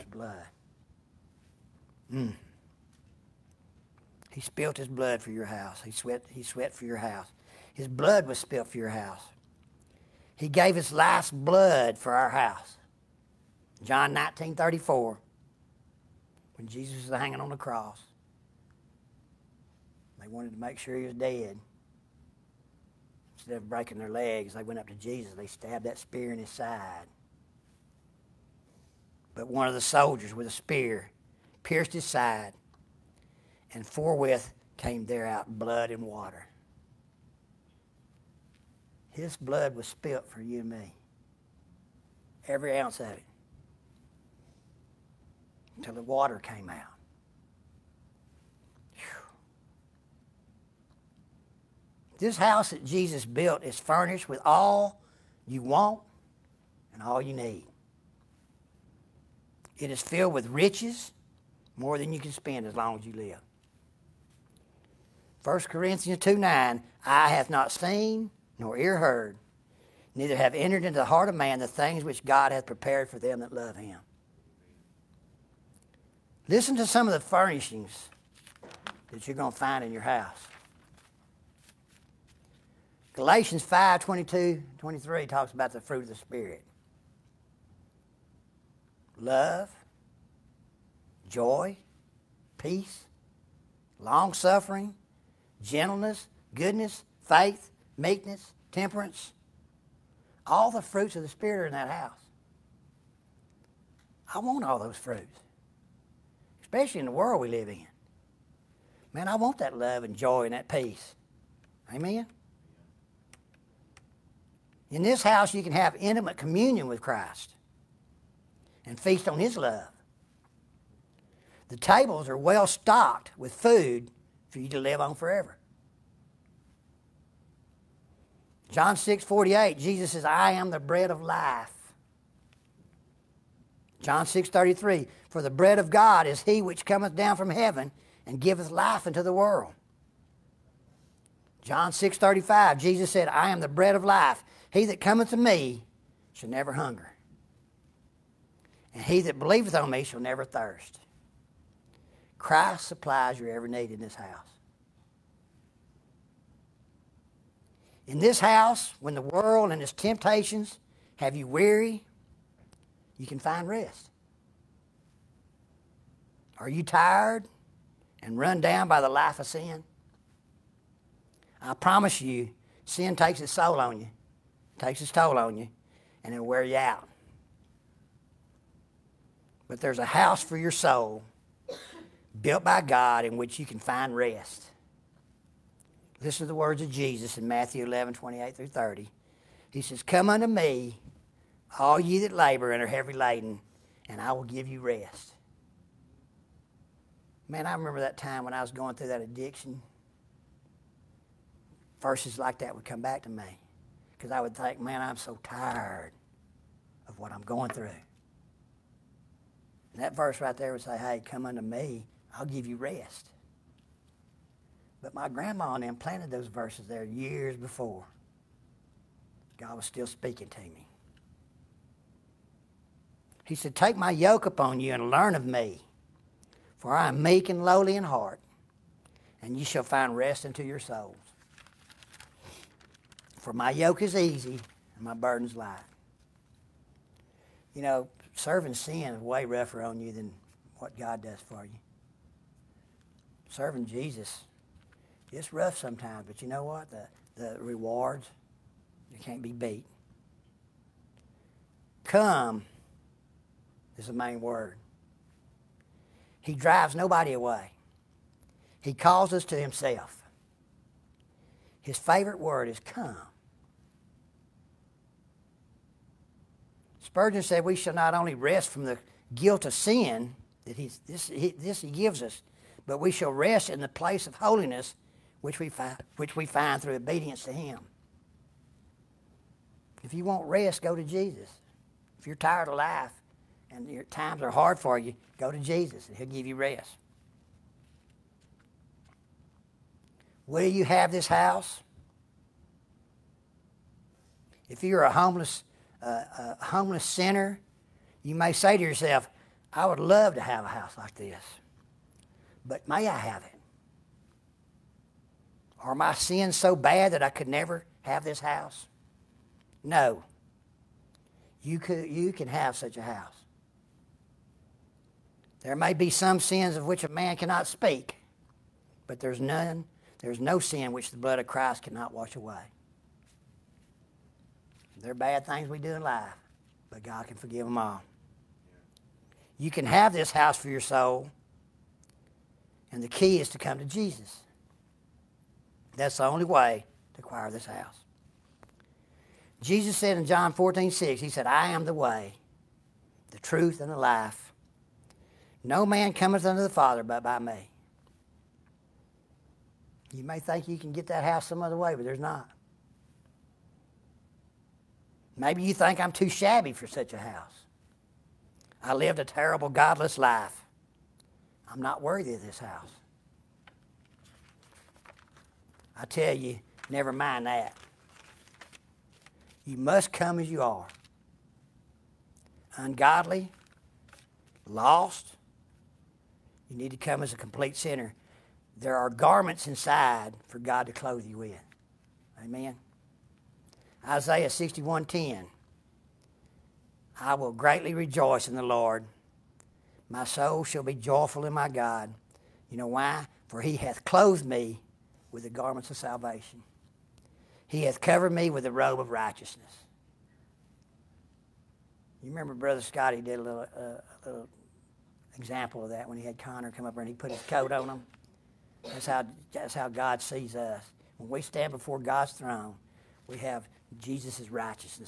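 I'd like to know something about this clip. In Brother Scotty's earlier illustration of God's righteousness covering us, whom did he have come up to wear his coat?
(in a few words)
Connor.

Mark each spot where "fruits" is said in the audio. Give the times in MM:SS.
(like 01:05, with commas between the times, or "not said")
01:25, 01:40, 01:44.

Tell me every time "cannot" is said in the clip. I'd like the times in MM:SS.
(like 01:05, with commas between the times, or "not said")
05:17, 05:21.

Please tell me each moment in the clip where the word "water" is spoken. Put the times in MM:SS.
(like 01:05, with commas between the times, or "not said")
00:36, 00:46.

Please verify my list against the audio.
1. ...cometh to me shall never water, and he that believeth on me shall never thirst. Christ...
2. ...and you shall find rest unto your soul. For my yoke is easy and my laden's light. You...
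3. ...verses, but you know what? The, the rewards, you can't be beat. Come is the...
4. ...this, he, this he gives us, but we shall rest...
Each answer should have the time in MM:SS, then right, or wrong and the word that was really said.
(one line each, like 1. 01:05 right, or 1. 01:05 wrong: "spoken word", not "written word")
1. 02:24 wrong: "hunger", not "water"
2. 03:49 wrong: "burden", not "laden"
3. 04:05 wrong: "sometimes", not "verses"
4. 04:31 right.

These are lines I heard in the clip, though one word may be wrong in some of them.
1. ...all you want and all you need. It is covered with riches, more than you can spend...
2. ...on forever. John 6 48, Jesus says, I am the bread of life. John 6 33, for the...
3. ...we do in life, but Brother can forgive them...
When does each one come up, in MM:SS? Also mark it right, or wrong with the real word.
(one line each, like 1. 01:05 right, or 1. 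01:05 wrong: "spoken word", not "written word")
1. 00:54 wrong: "filled", not "covered"
2. 02:04 right
3. 05:25 wrong: "God", not "Brother".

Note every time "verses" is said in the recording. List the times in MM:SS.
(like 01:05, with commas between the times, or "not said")
03:21, 03:30, 03:36.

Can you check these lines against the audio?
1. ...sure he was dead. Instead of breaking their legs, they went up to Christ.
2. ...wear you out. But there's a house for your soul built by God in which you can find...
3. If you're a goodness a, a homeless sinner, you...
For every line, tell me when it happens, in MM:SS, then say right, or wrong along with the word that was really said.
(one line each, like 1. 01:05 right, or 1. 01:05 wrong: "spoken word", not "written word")
1. 00:20 wrong: "Jesus", not "Christ"
2. 02:56 right
3. 04:54 wrong: "homeless", not "goodness".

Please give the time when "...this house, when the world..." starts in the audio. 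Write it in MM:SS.
02:38.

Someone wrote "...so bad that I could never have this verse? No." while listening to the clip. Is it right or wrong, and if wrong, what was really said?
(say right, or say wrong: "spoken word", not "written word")
wrong: "house", not "verse".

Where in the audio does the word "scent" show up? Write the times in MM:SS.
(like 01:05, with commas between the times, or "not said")
not said.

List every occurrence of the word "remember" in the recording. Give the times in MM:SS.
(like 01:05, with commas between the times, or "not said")
03:17, 06:42.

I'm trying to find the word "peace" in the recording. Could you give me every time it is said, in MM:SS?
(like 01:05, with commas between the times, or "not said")
01:32, 01:50.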